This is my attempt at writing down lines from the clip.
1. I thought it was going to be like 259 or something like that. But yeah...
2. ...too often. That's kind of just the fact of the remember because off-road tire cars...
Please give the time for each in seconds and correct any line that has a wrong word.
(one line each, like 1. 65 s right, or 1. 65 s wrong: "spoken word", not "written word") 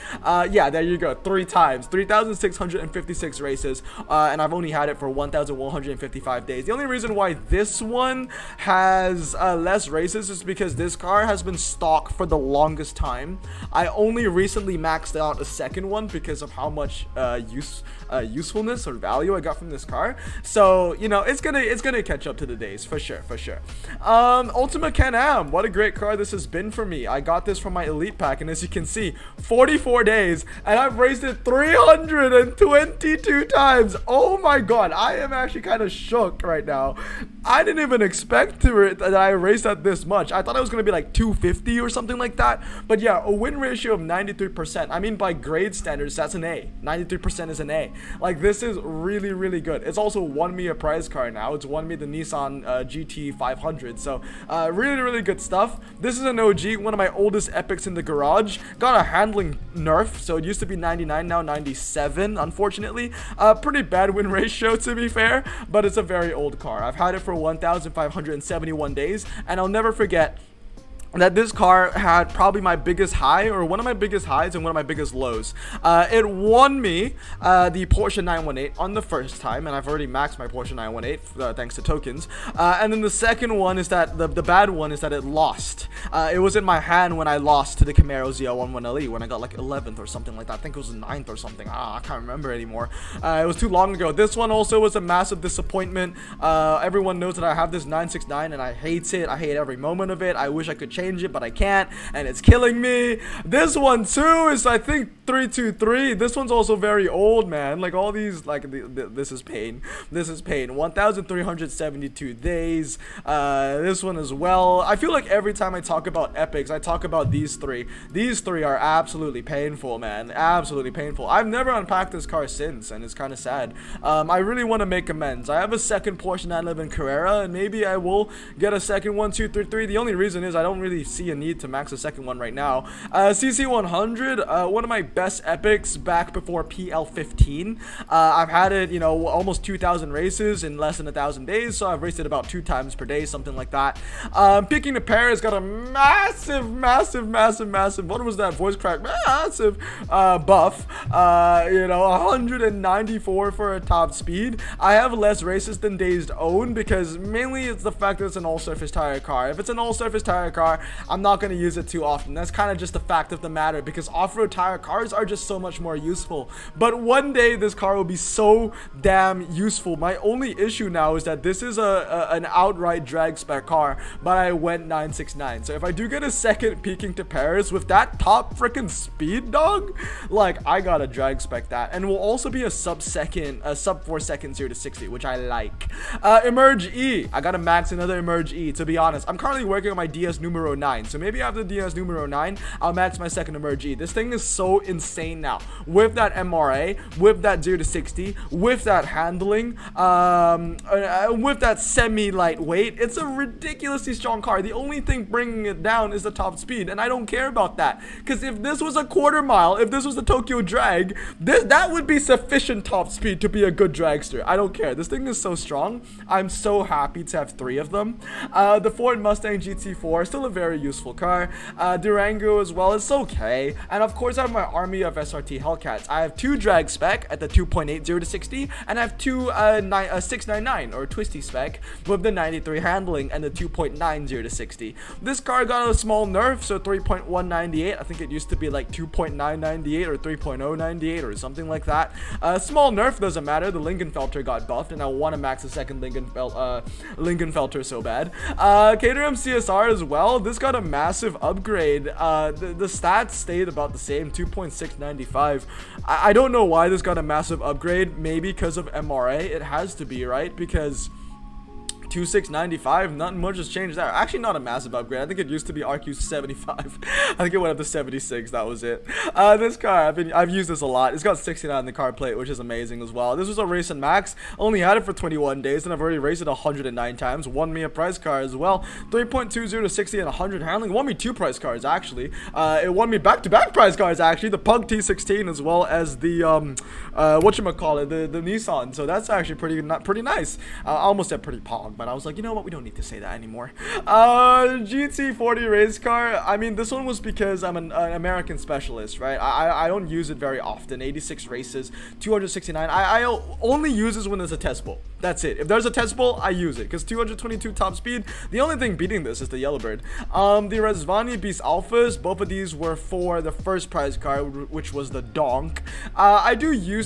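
1. 40 s wrong: "250", not "259"
2. 161 s wrong: "matter", not "remember".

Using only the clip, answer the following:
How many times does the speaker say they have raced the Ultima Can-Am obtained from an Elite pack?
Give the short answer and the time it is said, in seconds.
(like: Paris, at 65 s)
322, at 31 s.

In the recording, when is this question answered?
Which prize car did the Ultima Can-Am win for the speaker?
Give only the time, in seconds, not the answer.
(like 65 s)
52 s.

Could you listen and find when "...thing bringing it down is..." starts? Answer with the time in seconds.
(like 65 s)
205 s.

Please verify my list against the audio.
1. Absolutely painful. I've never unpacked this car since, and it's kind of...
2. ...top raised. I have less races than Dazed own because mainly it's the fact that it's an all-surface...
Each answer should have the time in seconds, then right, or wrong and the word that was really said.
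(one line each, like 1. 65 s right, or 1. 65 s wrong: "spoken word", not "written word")
1. 120 s right
2. 153 s wrong: "speed", not "raised".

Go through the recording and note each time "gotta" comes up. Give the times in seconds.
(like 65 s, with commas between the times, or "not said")
180 s, 187 s.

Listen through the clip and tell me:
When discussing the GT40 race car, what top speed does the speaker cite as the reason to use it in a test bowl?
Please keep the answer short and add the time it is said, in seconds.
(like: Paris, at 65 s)
222, at 307 s.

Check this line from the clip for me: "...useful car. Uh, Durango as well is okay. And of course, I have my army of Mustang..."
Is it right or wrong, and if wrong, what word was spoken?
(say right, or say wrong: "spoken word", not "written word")
wrong: "SRT", not "Mustang".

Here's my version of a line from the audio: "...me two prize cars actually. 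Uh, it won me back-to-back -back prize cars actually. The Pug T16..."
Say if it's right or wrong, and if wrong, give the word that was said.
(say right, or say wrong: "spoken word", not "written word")
right.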